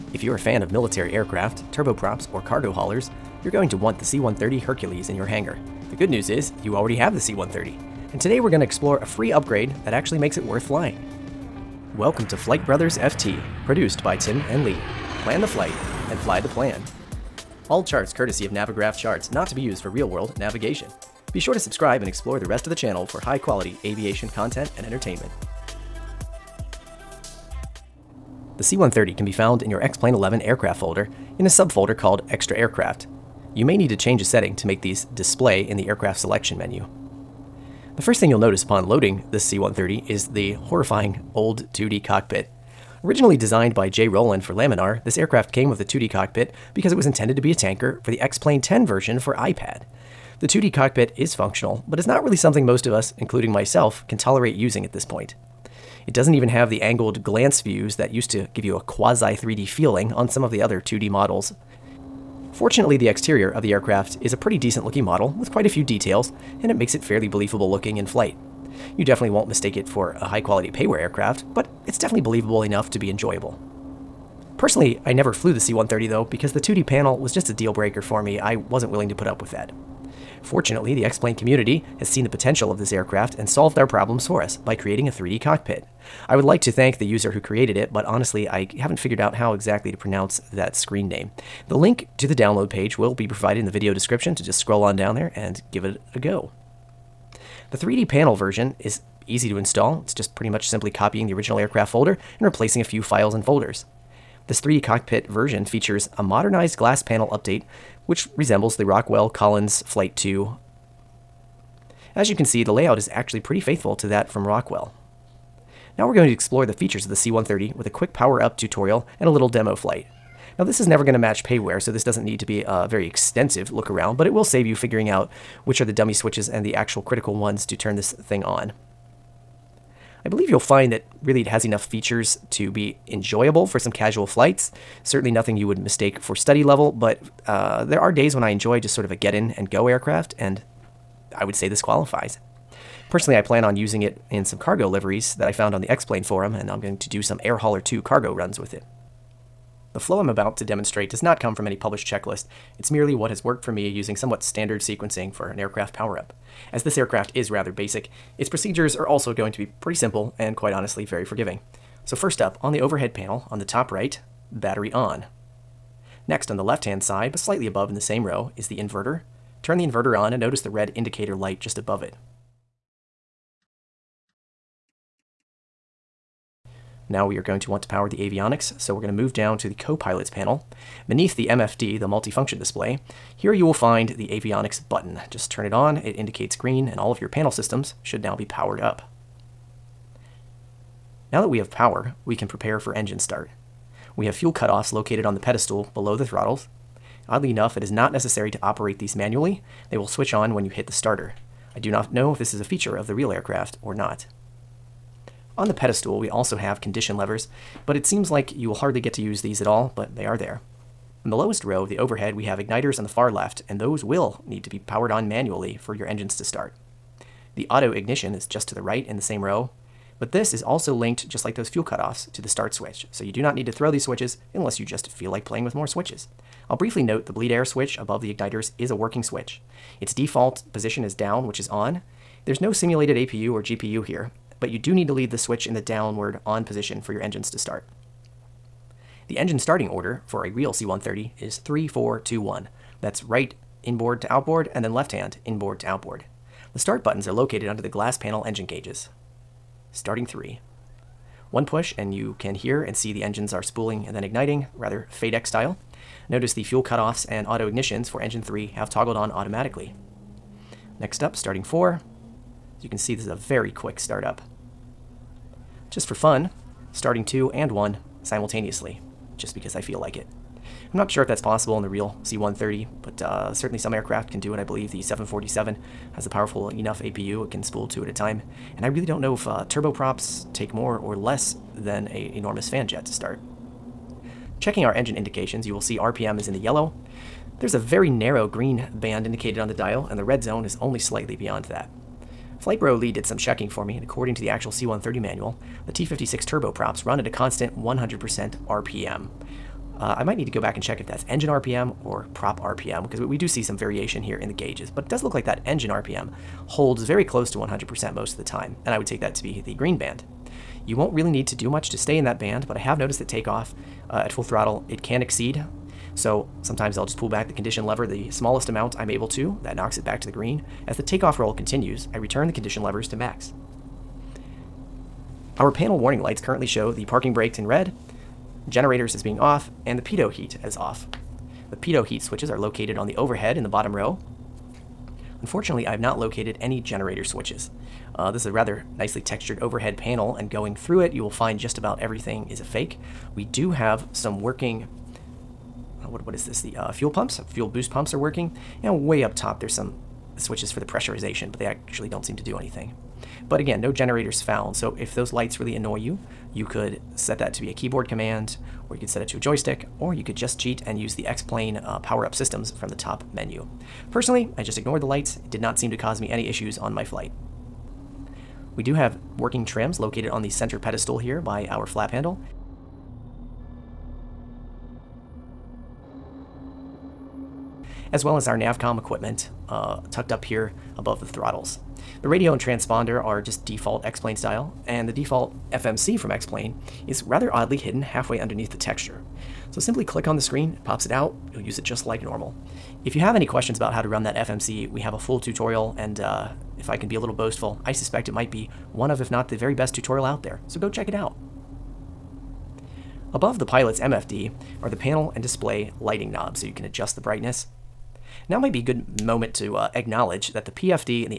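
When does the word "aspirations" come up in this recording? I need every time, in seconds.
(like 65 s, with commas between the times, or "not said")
not said.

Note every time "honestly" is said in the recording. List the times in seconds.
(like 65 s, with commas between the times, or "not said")
88 s, 160 s.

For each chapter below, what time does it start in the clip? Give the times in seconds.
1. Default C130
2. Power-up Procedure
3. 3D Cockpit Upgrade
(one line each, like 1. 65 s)
1. 27 s
2. 149 s
3. 80 s.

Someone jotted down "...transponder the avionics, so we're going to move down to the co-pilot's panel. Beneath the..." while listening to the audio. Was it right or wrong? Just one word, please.
wrong.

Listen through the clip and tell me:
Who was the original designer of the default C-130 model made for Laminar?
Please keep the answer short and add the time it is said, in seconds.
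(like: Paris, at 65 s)
Jay Rowland, at 43 s.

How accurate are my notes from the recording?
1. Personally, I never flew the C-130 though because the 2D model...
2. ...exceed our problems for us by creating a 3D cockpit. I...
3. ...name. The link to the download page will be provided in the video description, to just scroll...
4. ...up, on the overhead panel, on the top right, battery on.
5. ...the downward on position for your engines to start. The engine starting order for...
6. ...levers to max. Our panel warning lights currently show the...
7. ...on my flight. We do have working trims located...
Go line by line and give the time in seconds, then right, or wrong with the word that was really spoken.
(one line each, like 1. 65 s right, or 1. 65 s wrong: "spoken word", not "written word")
1. 74 s wrong: "panel", not "model"
2. 83 s wrong: "solved", not "exceed"
3. 91 s right
4. 162 s right
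5. 235 s right
6. 322 s right
7. 366 s right.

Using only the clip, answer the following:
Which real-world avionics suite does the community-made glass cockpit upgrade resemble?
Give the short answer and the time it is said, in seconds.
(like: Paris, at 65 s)
Rockwell Collins Flight 2, at 108 s.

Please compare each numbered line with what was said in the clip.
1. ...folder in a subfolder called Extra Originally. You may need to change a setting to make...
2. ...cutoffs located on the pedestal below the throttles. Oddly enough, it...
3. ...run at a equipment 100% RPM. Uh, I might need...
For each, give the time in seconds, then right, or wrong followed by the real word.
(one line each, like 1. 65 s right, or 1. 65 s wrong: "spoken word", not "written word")
1. 30 s wrong: "Aircraft", not "Originally"
2. 194 s right
3. 297 s wrong: "constant", not "equipment".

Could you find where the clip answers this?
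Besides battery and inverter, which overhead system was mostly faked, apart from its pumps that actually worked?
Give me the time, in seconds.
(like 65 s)
347 s.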